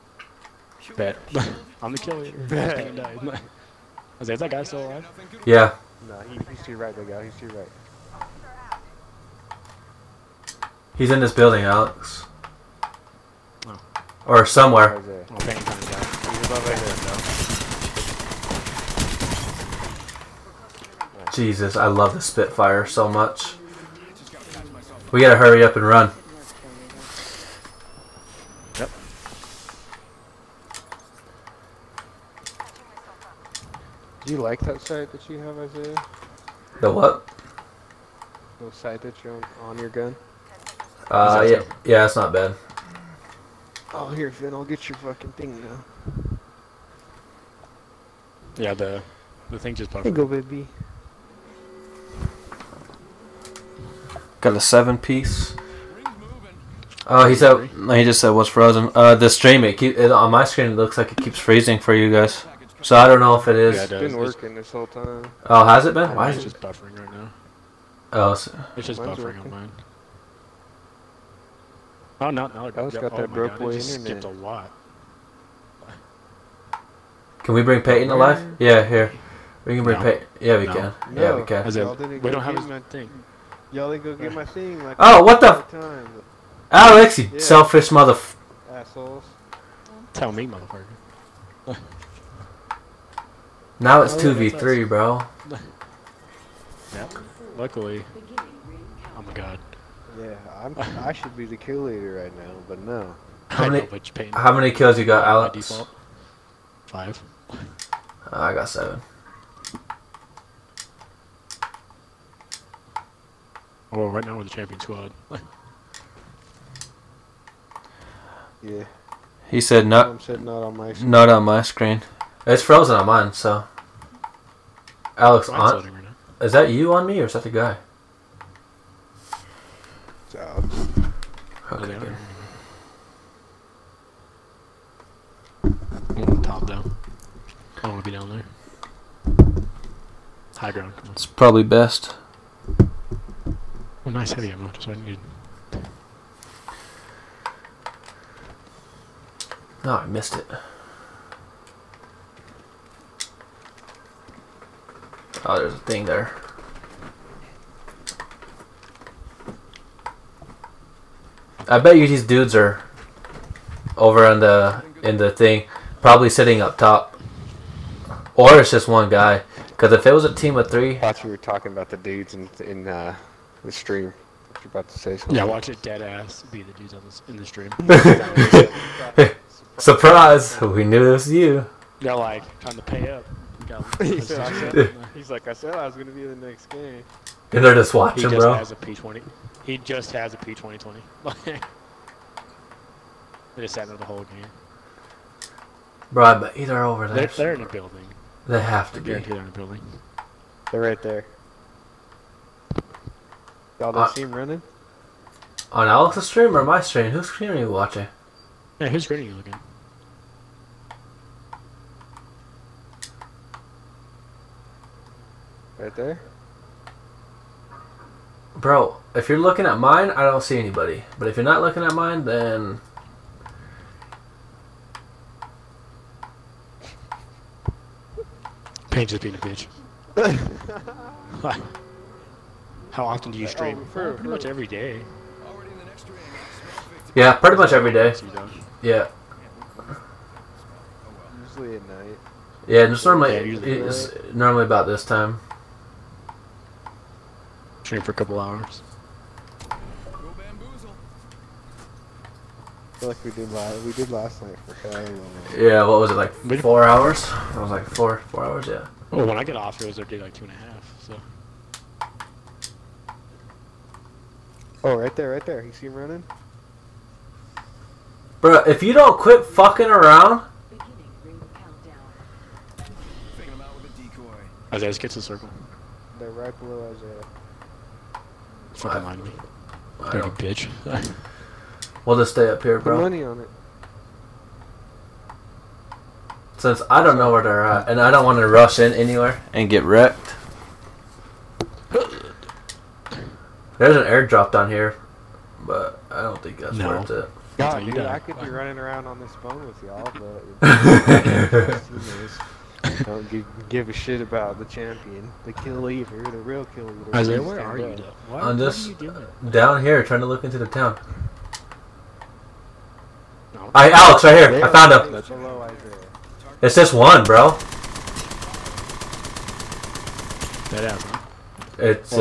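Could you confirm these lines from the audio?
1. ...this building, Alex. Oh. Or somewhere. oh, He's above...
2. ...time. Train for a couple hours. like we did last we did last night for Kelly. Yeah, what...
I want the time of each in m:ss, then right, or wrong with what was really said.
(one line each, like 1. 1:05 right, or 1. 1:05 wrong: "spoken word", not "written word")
1. 0:11 right
2. 4:05 right.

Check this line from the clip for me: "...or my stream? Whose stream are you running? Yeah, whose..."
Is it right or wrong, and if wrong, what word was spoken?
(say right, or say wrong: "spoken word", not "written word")
wrong: "watching", not "running".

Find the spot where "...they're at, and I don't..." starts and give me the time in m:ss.
4:47.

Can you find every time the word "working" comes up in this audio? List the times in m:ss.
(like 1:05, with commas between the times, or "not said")
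1:04, 1:09.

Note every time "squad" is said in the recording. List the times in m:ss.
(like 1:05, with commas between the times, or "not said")
1:54.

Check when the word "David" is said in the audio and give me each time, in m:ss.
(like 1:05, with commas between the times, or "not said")
not said.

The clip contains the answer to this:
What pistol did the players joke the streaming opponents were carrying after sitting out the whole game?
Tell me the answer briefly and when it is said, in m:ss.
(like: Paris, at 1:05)
P2020, at 3:10.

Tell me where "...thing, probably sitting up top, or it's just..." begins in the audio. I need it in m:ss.
2:45.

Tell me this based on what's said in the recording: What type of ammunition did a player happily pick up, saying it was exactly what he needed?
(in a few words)
Heavy ammo.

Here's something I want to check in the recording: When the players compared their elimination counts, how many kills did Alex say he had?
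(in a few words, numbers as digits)
5.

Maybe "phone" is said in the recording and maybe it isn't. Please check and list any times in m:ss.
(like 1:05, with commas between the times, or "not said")
4:59.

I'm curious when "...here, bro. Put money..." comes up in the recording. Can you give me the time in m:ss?
4:42.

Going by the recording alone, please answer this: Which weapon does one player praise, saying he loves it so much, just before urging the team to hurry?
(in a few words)
Spitfire.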